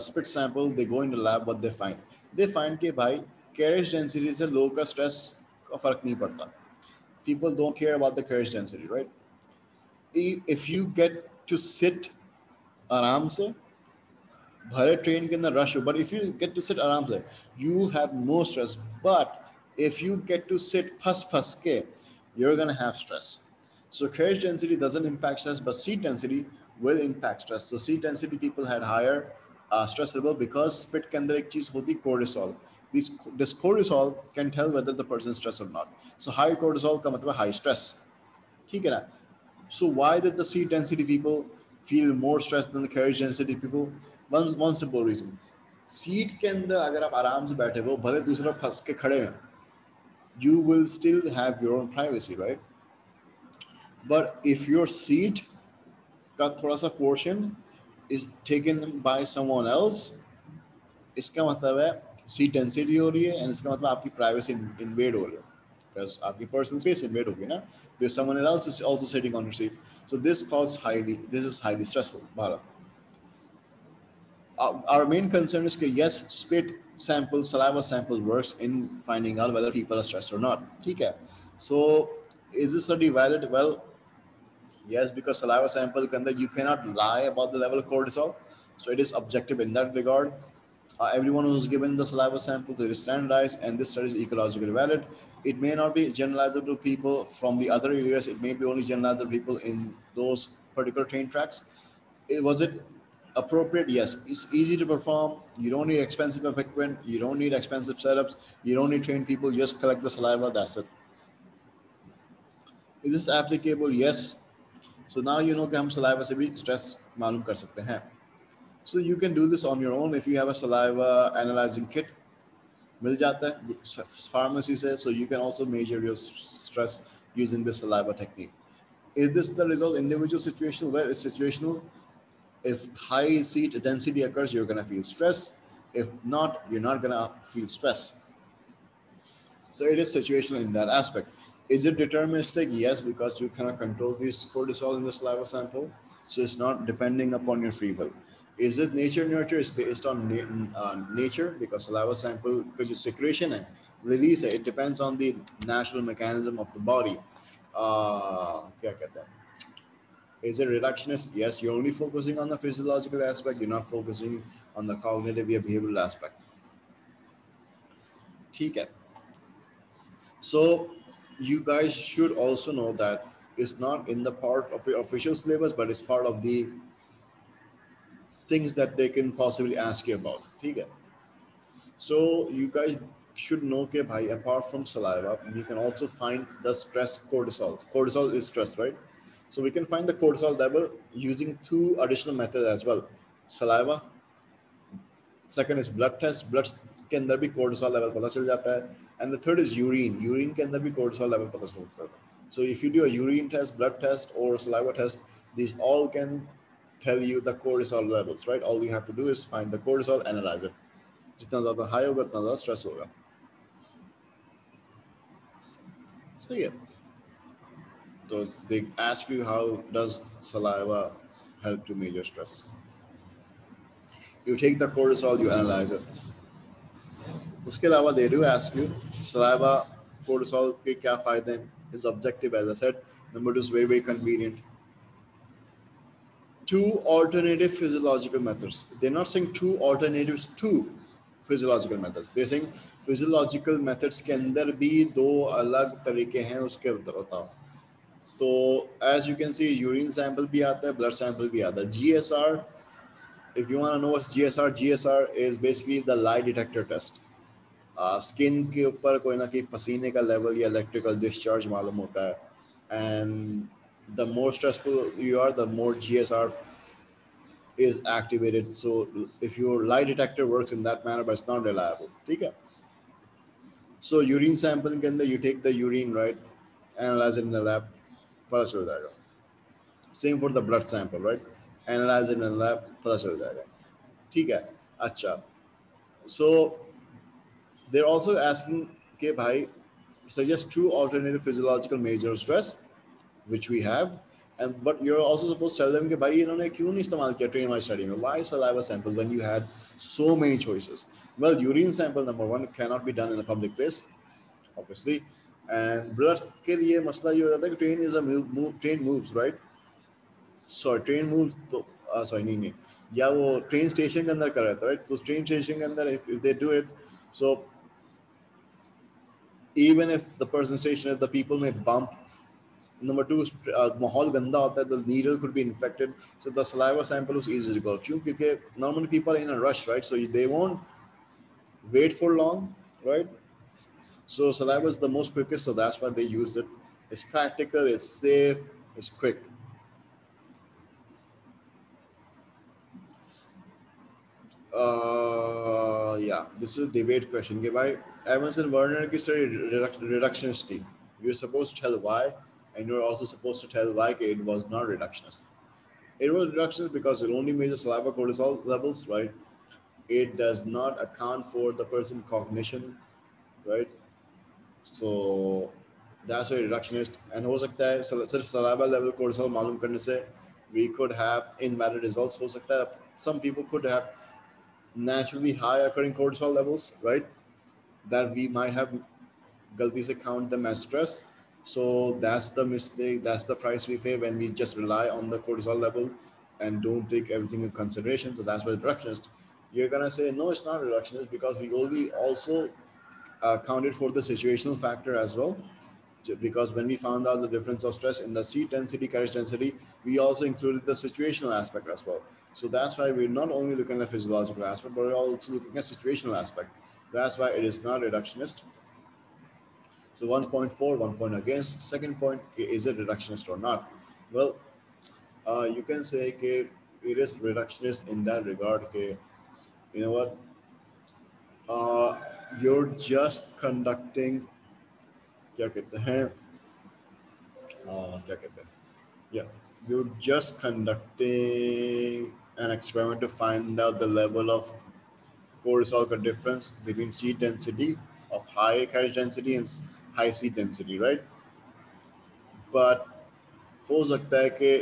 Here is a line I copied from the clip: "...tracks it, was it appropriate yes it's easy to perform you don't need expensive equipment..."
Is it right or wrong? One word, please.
right.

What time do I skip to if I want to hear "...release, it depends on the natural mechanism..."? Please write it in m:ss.
2:34.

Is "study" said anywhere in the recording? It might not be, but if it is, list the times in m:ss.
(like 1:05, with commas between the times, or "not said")
1:22, 1:33, 4:57.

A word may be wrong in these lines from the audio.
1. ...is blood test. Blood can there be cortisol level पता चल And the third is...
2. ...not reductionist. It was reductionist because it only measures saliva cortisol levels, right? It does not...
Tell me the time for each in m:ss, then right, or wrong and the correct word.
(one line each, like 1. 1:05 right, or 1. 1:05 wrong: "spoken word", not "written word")
1. 3:15 right
2. 5:54 right.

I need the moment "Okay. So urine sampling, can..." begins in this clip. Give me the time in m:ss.
4:32.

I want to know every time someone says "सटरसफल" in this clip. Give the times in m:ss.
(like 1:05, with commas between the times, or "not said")
4:24.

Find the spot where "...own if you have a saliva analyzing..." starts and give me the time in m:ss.
1:59.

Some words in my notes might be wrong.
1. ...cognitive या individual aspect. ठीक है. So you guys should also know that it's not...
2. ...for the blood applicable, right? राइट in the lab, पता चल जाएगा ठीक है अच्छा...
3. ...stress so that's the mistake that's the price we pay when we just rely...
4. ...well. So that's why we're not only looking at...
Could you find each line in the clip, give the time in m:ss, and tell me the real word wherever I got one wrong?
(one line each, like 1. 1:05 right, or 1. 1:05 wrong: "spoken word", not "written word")
1. 2:44 wrong: "behavioral", not "individual"
2. 4:40 wrong: "sample", not "applicable"
3. 6:20 right
4. 6:42 right.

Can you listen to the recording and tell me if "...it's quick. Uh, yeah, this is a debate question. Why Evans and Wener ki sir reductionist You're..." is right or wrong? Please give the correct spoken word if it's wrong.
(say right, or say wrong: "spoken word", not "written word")
right.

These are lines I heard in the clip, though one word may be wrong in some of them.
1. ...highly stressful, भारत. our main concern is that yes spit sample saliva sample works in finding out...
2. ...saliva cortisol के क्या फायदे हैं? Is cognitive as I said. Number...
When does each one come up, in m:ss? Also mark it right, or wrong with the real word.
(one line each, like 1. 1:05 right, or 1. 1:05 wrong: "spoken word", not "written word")
1. 1:11 right
2. 3:49 wrong: "objective", not "cognitive".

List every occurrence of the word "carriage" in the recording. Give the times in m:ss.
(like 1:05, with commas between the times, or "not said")
0:03, 0:08, 0:24, 0:42, 6:39, 7:18.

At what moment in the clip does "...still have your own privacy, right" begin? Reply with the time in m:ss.
0:50.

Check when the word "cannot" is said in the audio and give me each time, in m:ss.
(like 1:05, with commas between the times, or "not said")
1:26, 2:23, 5:02.